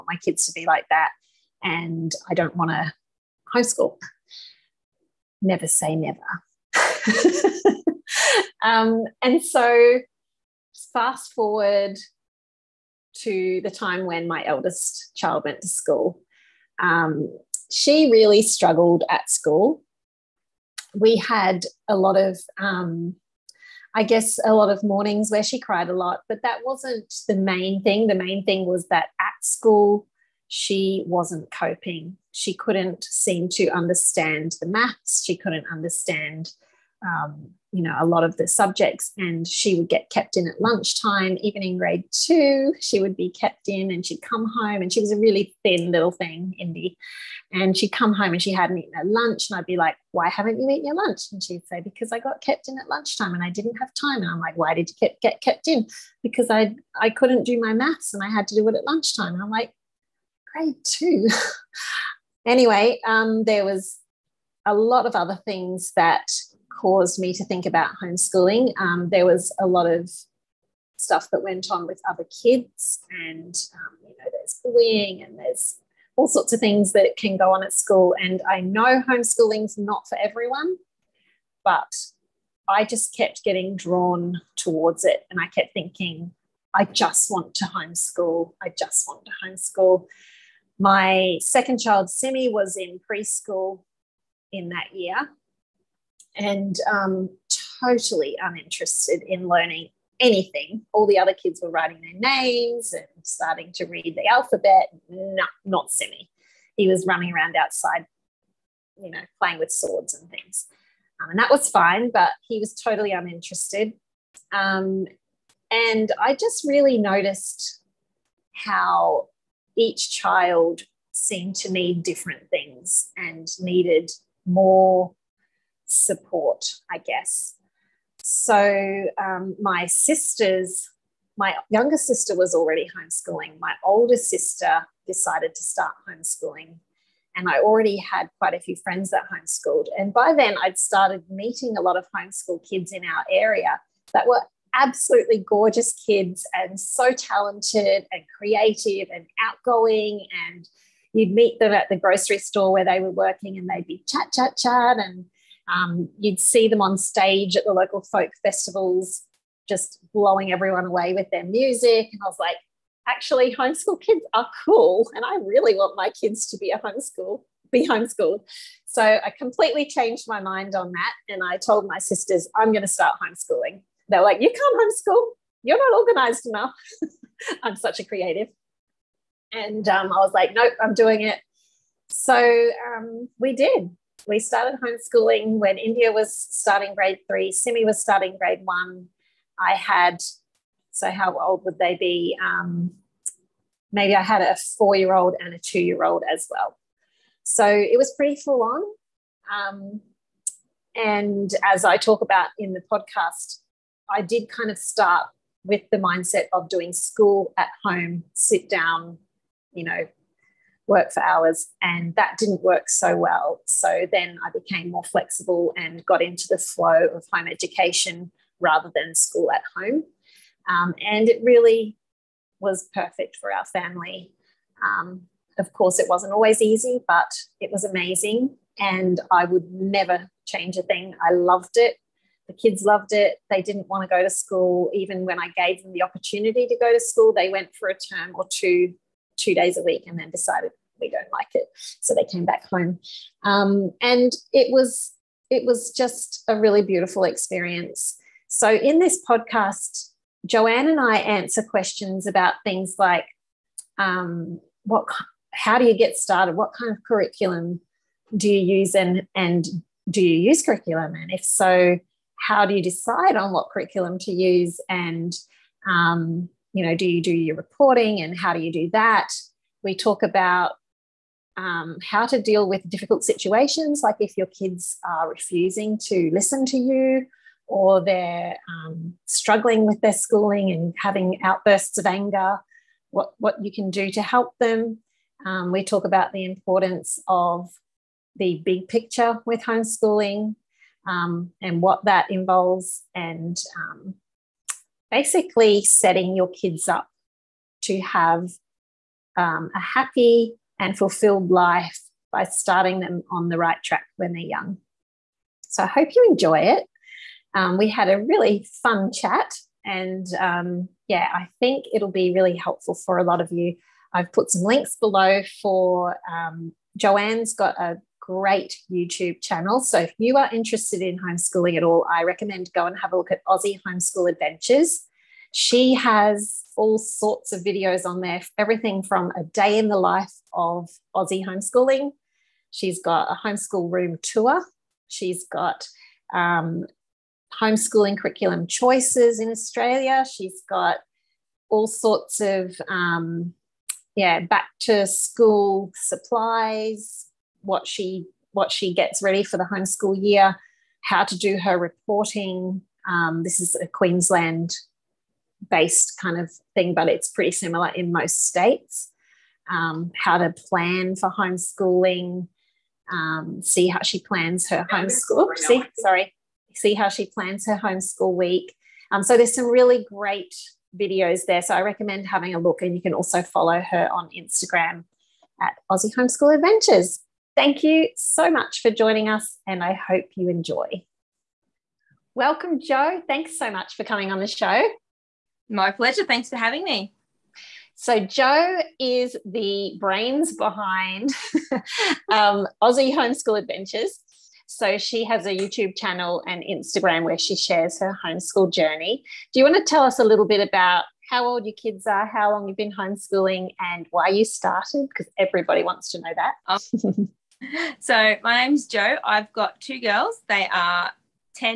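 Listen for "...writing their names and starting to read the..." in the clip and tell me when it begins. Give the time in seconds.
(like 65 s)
101 s.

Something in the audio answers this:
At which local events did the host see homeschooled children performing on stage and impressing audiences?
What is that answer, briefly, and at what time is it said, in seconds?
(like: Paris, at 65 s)
folk festivals, at 158 s.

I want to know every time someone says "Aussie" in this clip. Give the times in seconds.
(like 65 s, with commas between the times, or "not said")
323 s, 331 s, 375 s, 392 s.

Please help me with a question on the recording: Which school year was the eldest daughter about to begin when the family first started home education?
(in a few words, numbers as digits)
Grade 3.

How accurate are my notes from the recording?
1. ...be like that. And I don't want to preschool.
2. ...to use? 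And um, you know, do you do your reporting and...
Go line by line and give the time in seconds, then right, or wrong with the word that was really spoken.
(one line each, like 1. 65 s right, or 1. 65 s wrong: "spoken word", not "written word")
1. 0 s wrong: "homeschool", not "preschool"
2. 264 s right.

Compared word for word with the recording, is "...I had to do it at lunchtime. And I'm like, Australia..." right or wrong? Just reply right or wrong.
wrong.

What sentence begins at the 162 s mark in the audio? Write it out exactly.
And I was like, actually, homeschool kids are cool.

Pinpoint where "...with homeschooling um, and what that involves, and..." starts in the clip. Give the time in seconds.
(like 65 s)
289 s.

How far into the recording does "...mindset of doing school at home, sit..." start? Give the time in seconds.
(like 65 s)
205 s.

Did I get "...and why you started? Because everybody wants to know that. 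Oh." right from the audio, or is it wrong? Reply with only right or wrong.
right.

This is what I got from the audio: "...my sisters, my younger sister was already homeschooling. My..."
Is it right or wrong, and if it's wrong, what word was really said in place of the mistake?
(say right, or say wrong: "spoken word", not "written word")
right.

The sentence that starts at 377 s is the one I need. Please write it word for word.
Thank you so much for joining us, and I hope you enjoy.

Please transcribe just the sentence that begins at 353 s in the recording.
Um, this is a Queensland based kind of thing, but it's pretty similar in most states.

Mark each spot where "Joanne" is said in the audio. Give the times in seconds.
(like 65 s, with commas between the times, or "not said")
250 s, 316 s.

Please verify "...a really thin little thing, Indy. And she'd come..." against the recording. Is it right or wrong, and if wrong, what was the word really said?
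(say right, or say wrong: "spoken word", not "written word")
right.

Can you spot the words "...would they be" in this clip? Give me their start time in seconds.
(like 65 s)
191 s.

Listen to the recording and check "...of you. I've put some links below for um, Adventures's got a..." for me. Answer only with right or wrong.
wrong.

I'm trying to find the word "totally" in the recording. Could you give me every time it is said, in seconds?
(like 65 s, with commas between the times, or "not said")
97 s, 112 s.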